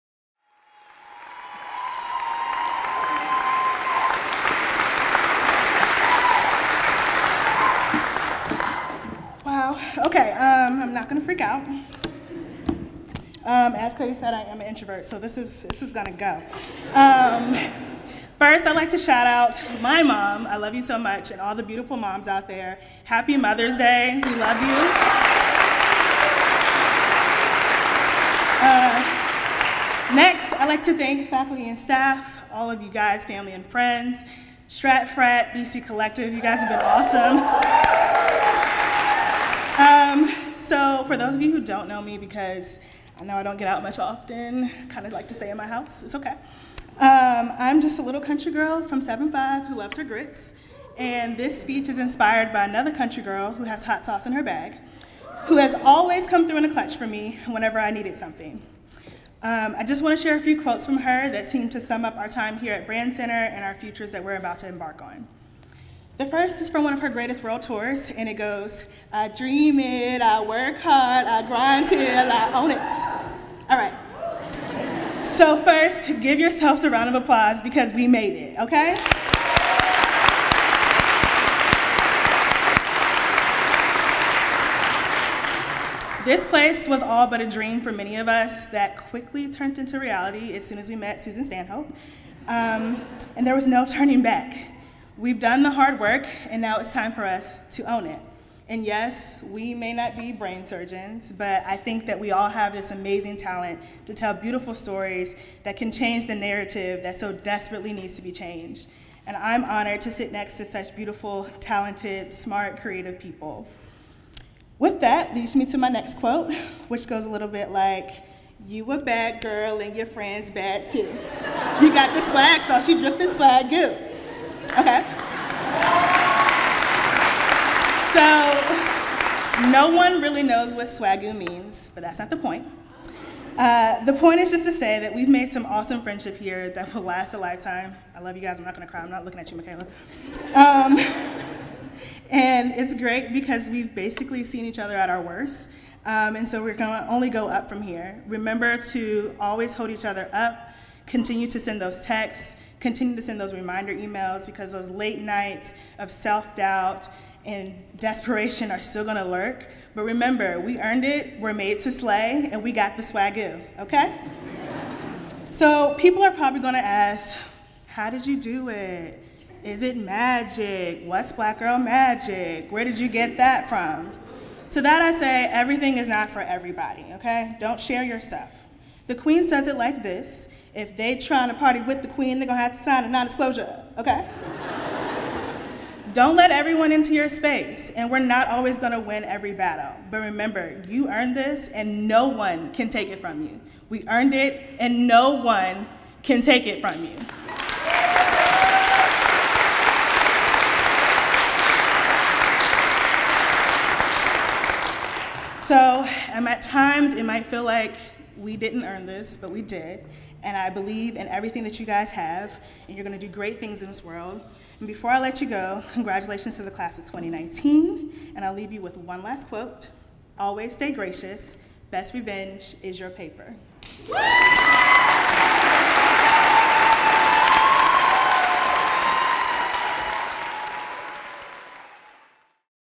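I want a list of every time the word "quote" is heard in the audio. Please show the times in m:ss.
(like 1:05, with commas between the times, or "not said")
1:00, 1:56, 3:39.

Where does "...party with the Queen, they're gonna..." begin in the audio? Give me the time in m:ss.
3:01.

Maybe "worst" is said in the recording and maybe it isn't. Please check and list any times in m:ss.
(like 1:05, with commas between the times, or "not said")
2:25.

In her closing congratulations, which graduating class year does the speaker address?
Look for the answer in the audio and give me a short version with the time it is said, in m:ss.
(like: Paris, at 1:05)
2019, at 3:37.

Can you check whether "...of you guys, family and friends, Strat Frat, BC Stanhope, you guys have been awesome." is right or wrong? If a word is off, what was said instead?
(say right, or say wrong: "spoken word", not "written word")
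wrong: "Collective", not "Stanhope".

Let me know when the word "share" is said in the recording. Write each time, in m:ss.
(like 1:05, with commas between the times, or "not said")
1:00, 2:57.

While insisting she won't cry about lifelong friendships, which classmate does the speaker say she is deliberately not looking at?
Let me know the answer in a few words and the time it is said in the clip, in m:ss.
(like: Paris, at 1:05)
Michaela, at 2:19.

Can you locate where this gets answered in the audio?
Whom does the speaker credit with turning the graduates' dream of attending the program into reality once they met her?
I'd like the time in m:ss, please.
1:31.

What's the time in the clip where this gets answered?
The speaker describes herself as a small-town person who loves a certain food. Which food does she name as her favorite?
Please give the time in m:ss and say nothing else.
0:50.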